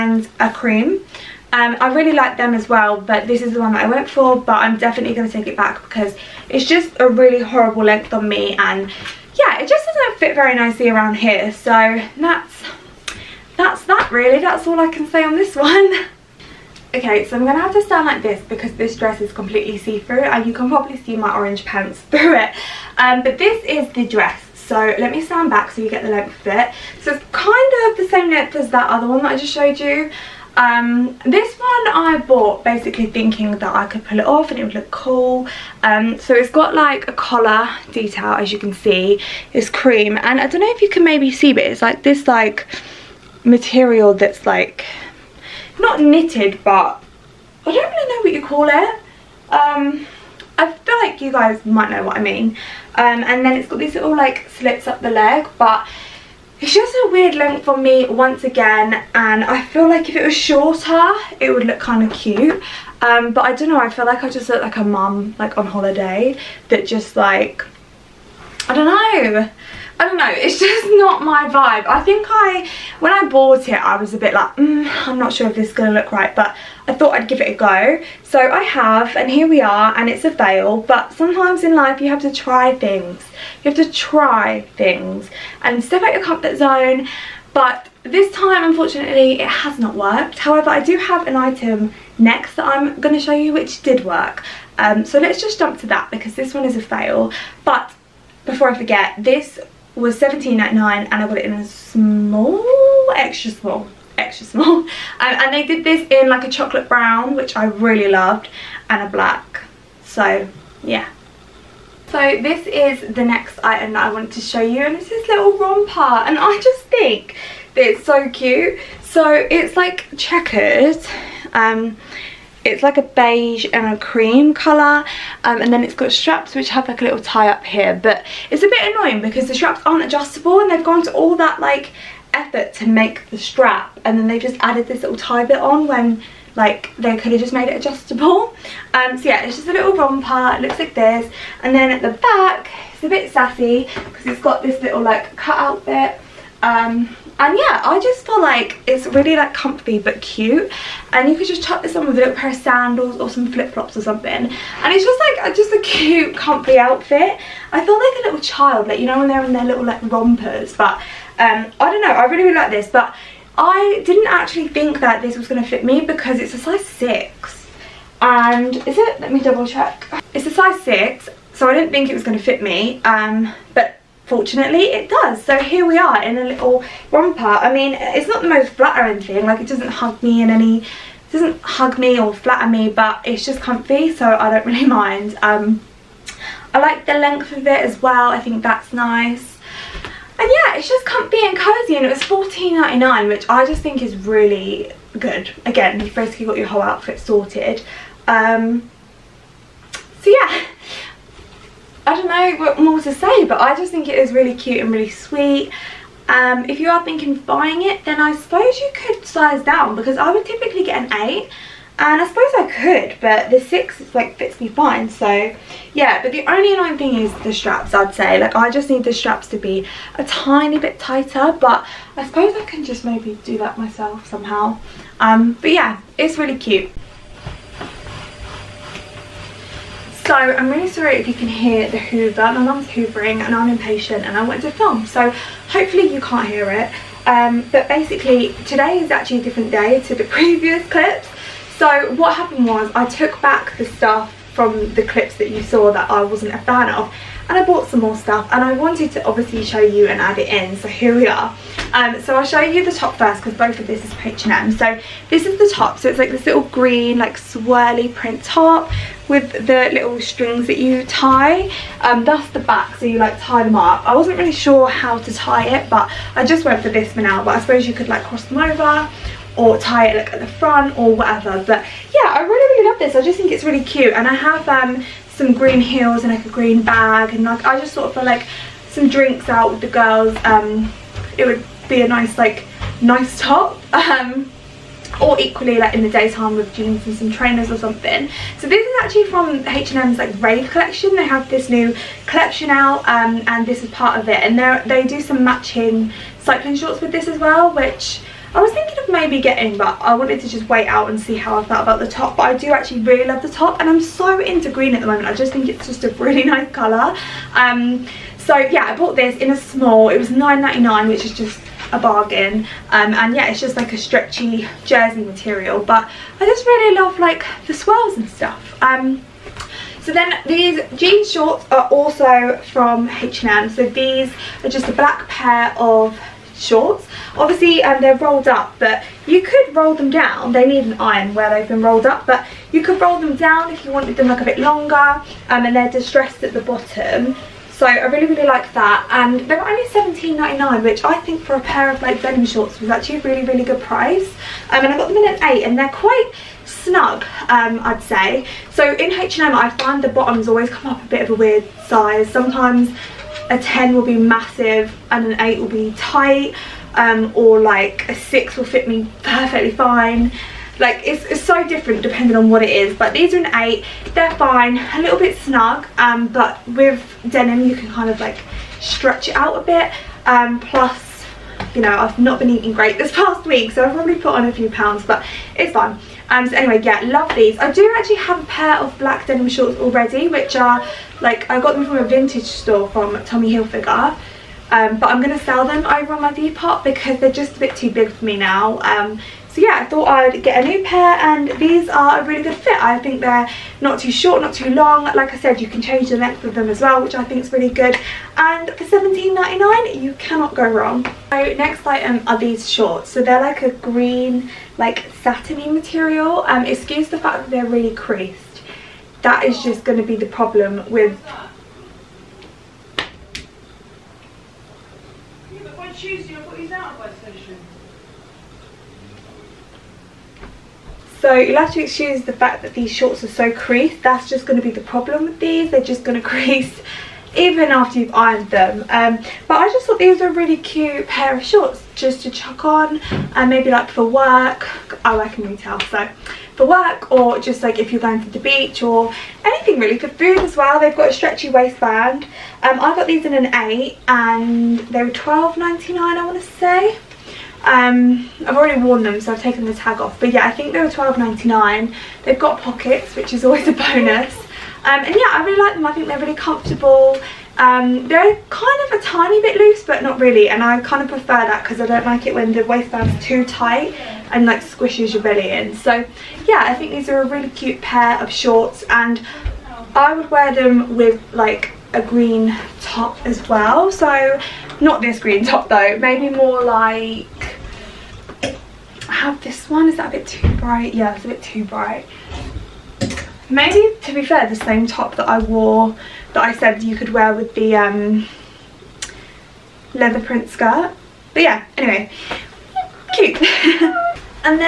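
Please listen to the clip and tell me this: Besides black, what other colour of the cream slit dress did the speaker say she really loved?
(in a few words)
Chocolate brown.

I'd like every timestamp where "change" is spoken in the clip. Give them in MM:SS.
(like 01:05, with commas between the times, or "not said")
06:35.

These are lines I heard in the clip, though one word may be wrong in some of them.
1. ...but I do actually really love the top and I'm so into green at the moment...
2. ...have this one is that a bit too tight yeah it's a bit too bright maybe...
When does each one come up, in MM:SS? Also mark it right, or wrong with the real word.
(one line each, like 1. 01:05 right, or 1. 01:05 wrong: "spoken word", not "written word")
1. 05:02 right
2. 07:59 wrong: "bright", not "tight".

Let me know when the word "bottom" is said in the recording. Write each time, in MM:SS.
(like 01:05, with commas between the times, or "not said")
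05:36, 05:50.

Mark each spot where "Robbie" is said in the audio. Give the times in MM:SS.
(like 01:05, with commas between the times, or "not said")
not said.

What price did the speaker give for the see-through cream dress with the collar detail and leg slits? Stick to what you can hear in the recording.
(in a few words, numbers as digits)
17.99.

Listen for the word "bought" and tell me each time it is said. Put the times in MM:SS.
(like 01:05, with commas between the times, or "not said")
00:32, 01:13, 04:07, 05:08.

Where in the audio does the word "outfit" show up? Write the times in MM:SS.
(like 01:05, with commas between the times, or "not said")
02:36, 03:16.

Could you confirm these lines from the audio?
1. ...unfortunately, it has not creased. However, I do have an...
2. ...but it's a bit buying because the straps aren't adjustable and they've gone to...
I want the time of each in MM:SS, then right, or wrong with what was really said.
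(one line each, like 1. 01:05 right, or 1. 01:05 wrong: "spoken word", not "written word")
1. 01:28 wrong: "worked", not "creased"
2. 02:08 wrong: "annoying", not "buying".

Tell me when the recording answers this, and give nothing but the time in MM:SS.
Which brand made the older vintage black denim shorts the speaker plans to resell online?
06:23.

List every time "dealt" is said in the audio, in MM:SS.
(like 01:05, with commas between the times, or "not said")
not said.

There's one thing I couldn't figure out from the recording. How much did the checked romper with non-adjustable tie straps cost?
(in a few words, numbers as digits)
$14.99.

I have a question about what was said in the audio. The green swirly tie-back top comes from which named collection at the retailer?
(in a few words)
Rave collection.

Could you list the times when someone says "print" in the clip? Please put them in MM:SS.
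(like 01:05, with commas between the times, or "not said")
04:18, 08:10.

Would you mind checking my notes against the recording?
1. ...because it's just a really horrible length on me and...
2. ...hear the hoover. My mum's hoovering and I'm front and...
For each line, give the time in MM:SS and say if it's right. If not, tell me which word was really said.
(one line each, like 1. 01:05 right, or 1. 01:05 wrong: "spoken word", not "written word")
1. 00:05 right
2. 03:51 wrong: "impatient", not "front".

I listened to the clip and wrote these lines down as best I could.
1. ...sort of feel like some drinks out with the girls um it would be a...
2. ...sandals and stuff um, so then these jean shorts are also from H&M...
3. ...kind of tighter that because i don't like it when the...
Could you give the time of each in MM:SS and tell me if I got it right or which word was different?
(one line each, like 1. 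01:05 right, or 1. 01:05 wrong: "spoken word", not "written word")
1. 04:37 right
2. 05:17 wrong: "swirls", not "sandals"
3. 07:40 wrong: "prefer", not "tighter".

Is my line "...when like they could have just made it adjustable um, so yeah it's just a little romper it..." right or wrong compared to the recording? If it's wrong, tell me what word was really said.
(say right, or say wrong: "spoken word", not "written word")
right.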